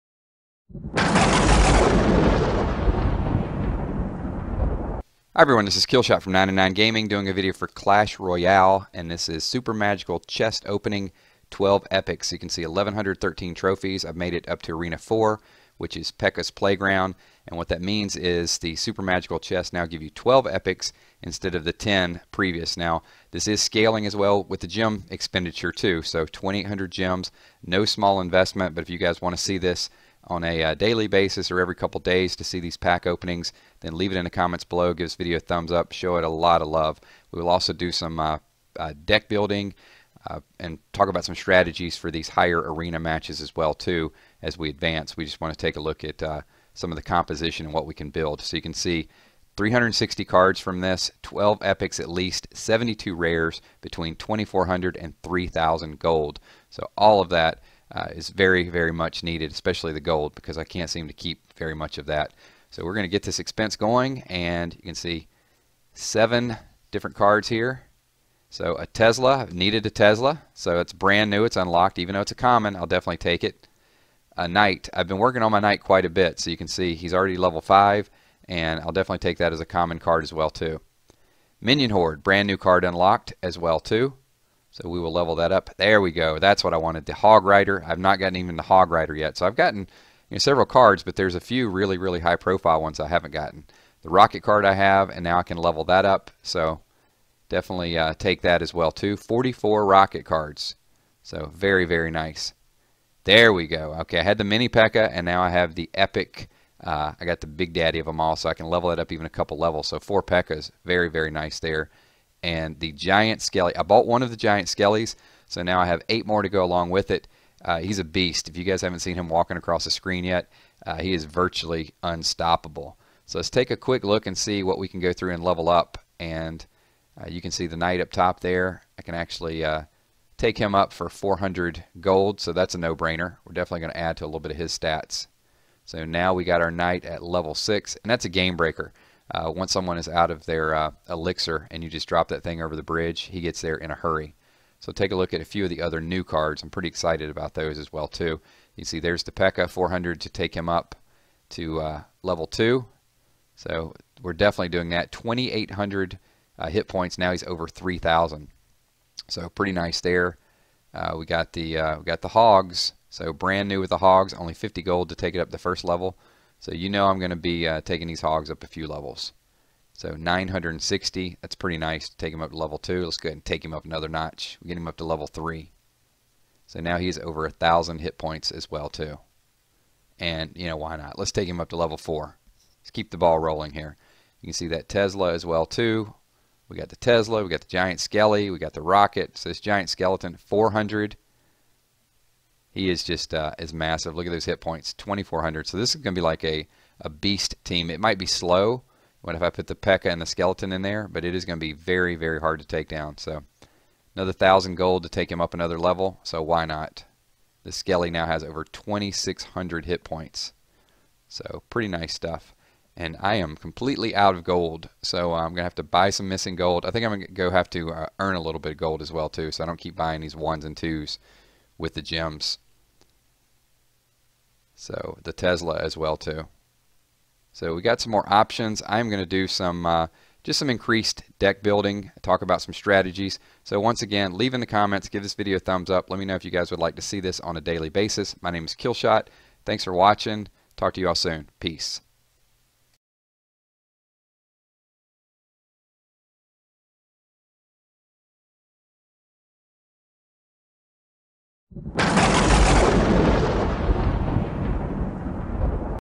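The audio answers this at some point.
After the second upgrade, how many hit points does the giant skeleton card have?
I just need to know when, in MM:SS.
03:28.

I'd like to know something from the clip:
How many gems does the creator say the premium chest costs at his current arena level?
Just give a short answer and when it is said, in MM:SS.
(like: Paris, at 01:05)
2800, at 00:26.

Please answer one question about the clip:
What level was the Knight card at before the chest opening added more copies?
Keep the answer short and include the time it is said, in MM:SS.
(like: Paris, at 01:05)
5, at 01:17.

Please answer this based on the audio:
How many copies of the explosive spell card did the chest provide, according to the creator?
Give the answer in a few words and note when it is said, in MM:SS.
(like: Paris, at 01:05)
44, at 01:39.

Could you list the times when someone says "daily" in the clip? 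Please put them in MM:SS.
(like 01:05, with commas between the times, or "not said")
00:30, 03:57.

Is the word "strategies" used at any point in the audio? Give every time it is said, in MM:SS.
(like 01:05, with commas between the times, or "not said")
00:41, 03:52.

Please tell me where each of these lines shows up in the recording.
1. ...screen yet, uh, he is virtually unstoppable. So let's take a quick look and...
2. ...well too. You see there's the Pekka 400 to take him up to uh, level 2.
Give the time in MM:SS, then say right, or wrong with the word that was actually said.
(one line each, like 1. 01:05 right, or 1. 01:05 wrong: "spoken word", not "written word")
1. 01:59 right
2. 02:27 right.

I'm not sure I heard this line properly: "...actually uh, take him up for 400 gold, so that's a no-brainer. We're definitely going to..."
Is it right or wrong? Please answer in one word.
right.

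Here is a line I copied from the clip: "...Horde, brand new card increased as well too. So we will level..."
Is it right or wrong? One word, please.
wrong.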